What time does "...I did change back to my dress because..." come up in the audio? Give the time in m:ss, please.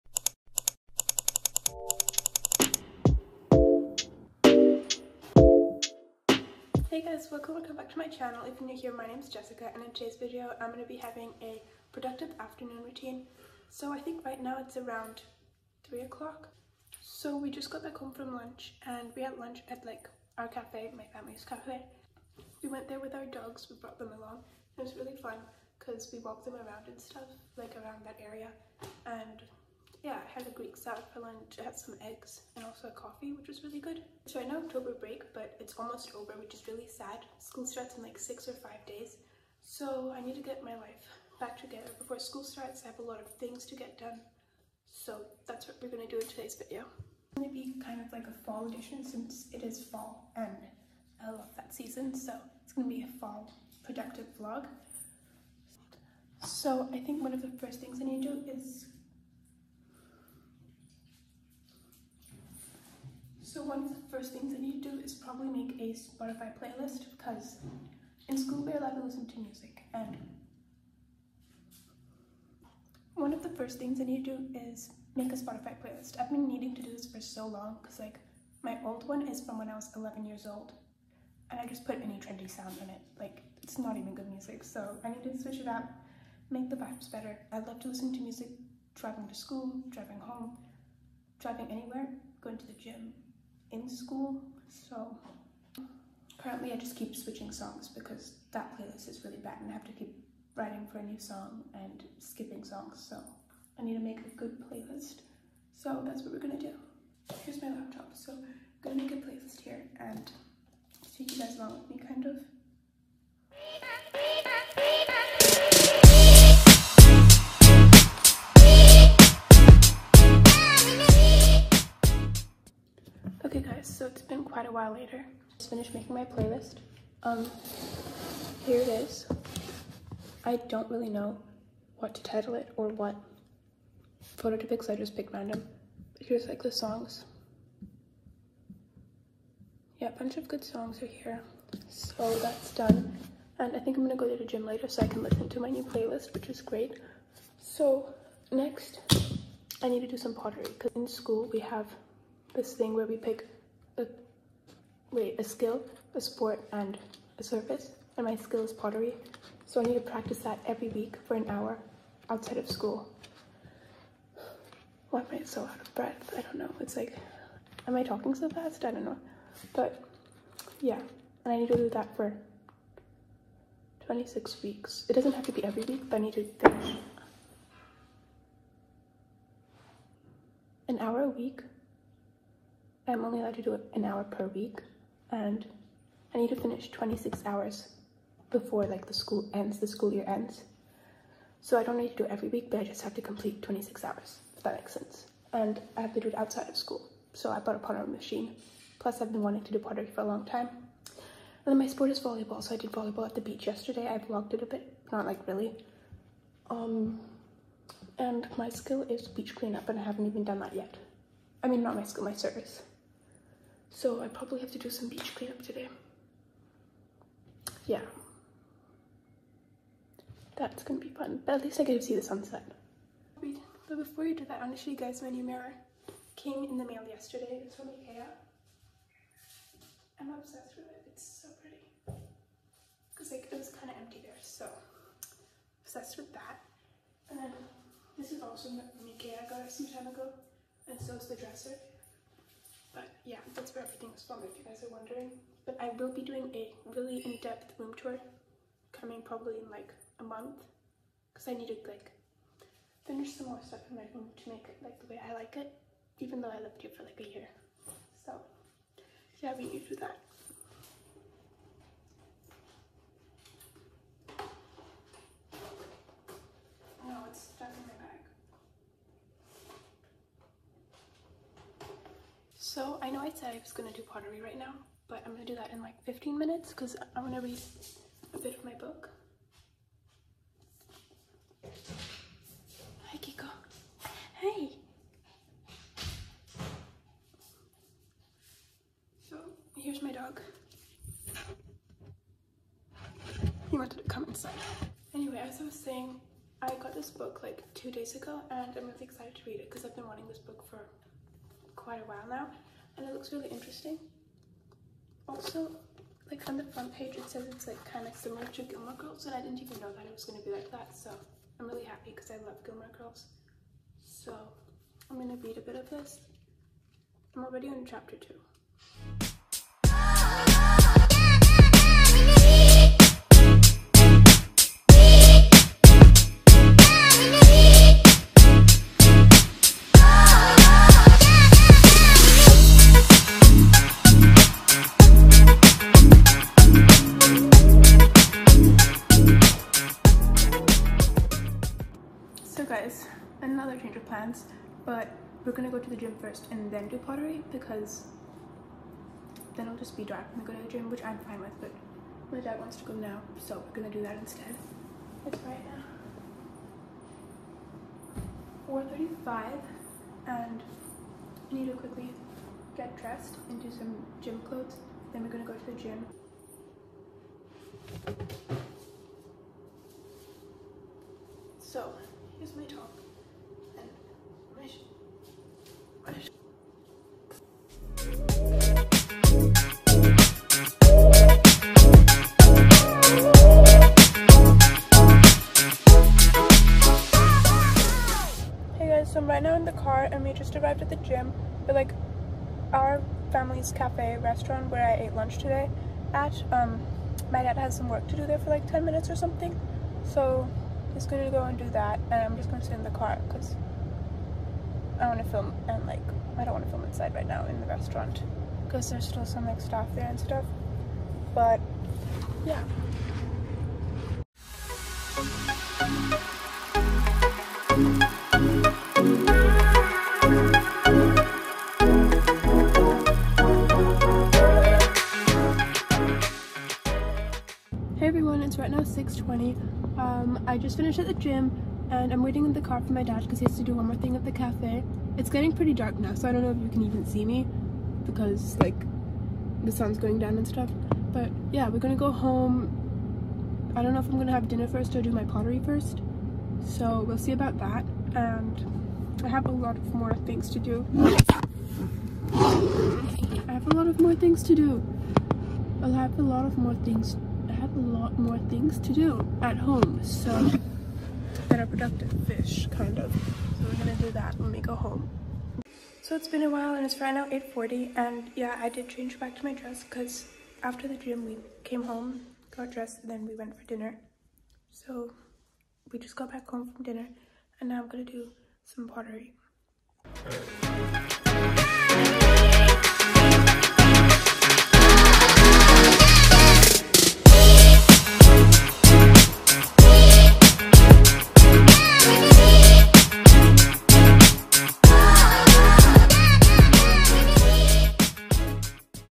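7:48.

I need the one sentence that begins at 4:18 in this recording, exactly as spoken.
So yeah, we need to do that.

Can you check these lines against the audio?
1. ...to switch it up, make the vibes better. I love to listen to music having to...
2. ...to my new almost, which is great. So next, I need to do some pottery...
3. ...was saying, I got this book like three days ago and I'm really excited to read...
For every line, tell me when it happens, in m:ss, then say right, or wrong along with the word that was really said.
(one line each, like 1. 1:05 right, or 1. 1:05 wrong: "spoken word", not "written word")
1. 1:25 wrong: "driving", not "having"
2. 2:25 wrong: "playlist", not "almost"
3. 4:55 wrong: "two", not "three".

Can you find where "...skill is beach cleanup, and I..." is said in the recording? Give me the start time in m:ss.
3:28.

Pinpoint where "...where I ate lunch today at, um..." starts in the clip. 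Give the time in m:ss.
6:34.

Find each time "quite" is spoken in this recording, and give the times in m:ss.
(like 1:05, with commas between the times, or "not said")
2:04, 5:01.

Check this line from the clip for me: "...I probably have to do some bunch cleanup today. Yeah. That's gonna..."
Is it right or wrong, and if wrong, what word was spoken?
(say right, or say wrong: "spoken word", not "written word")
wrong: "beach", not "bunch".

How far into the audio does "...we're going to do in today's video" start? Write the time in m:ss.
0:45.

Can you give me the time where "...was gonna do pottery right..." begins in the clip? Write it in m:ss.
4:33.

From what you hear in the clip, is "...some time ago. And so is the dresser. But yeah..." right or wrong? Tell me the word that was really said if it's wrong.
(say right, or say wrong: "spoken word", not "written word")
right.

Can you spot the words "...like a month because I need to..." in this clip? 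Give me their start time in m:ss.
4:09.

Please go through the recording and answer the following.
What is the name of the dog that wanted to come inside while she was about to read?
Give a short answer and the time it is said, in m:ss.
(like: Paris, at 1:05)
Kiko, at 4:43.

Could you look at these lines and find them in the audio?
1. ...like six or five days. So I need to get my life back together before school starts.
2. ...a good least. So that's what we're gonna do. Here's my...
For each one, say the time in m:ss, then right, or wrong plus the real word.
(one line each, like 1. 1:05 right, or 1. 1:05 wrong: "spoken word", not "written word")
1. 0:38 right
2. 1:44 wrong: "playlist", not "least".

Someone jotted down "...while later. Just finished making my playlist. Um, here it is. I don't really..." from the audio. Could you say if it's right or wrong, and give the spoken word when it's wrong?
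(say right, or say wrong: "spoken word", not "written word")
right.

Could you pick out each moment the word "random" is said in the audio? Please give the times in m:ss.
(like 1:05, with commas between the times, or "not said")
2:15.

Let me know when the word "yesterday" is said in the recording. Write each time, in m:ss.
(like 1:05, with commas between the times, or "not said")
3:23, 3:47.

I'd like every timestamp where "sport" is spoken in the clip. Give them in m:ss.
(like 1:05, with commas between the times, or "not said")
2:36, 3:21.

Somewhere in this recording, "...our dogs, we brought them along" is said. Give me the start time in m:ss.
0:23.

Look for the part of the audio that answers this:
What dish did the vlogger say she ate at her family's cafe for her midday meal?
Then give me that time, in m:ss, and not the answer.
0:30.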